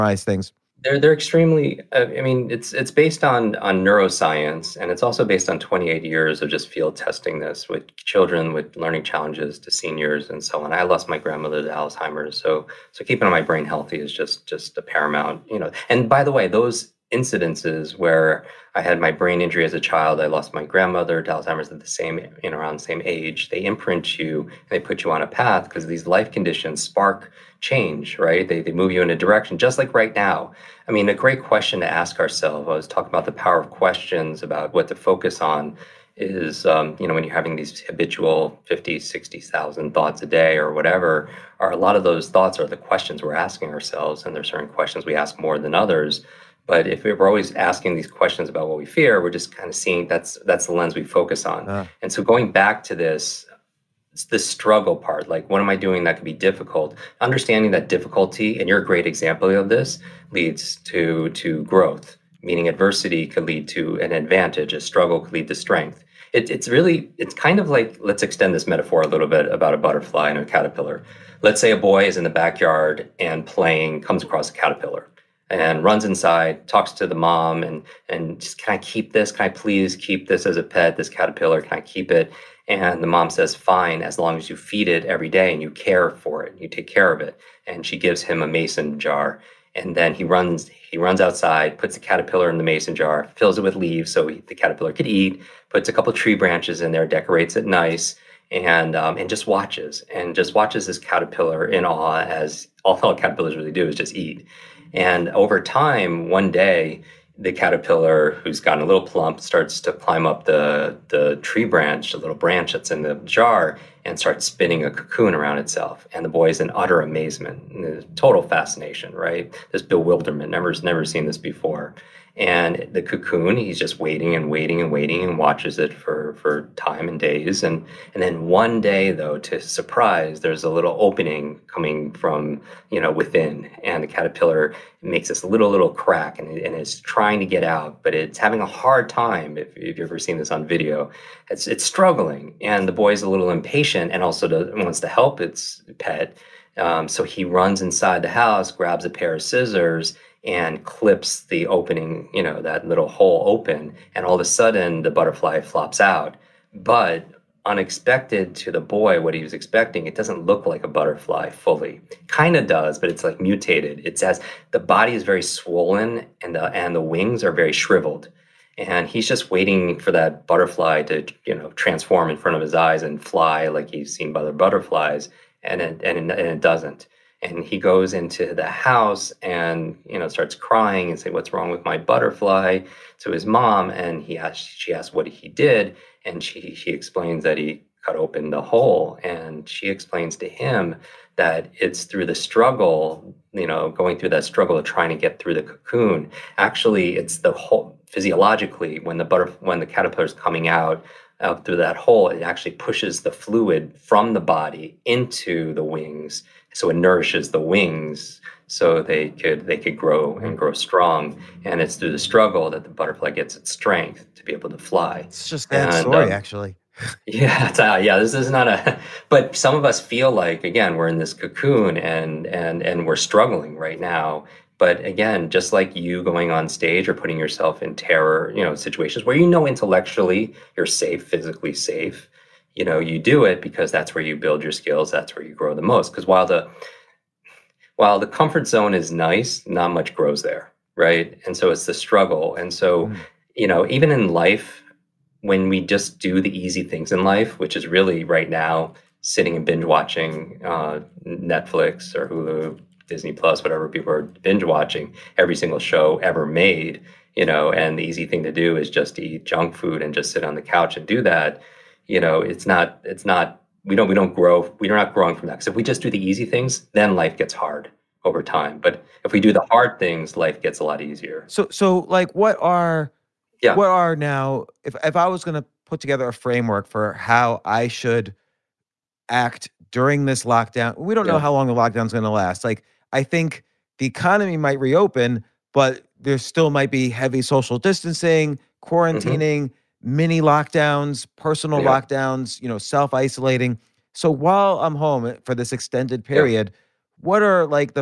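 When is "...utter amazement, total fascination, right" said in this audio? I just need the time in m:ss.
1:56.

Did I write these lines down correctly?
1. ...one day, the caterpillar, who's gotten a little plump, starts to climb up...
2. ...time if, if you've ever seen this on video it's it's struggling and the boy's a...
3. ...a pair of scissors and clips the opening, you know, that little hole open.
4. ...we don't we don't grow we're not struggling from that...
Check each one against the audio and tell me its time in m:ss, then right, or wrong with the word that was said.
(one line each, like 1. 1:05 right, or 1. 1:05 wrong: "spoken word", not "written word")
1. 1:46 right
2. 2:19 right
3. 2:29 right
4. 4:23 wrong: "growing", not "struggling".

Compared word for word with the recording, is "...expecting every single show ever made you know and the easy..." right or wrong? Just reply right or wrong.
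wrong.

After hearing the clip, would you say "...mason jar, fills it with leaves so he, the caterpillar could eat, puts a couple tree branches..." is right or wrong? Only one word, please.
right.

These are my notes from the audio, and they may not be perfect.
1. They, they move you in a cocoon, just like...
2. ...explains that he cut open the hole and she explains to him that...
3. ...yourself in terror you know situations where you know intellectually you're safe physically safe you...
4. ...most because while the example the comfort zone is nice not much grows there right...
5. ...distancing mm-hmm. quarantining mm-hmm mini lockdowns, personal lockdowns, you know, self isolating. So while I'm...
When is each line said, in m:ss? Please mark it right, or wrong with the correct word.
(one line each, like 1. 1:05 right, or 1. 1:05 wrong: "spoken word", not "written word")
1. 0:28 wrong: "direction", not "cocoon"
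2. 3:06 right
3. 3:47 right
4. 3:55 wrong: "while", not "example"
5. 4:47 right.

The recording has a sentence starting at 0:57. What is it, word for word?
Understanding that difficulty, and you're a great example of this, leads to to growth.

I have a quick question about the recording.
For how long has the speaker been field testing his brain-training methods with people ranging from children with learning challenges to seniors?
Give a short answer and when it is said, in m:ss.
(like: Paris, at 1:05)
28 years, at 0:05.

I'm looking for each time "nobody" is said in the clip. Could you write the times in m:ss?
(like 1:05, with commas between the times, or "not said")
not said.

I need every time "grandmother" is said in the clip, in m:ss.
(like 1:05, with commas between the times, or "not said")
0:11, 0:20.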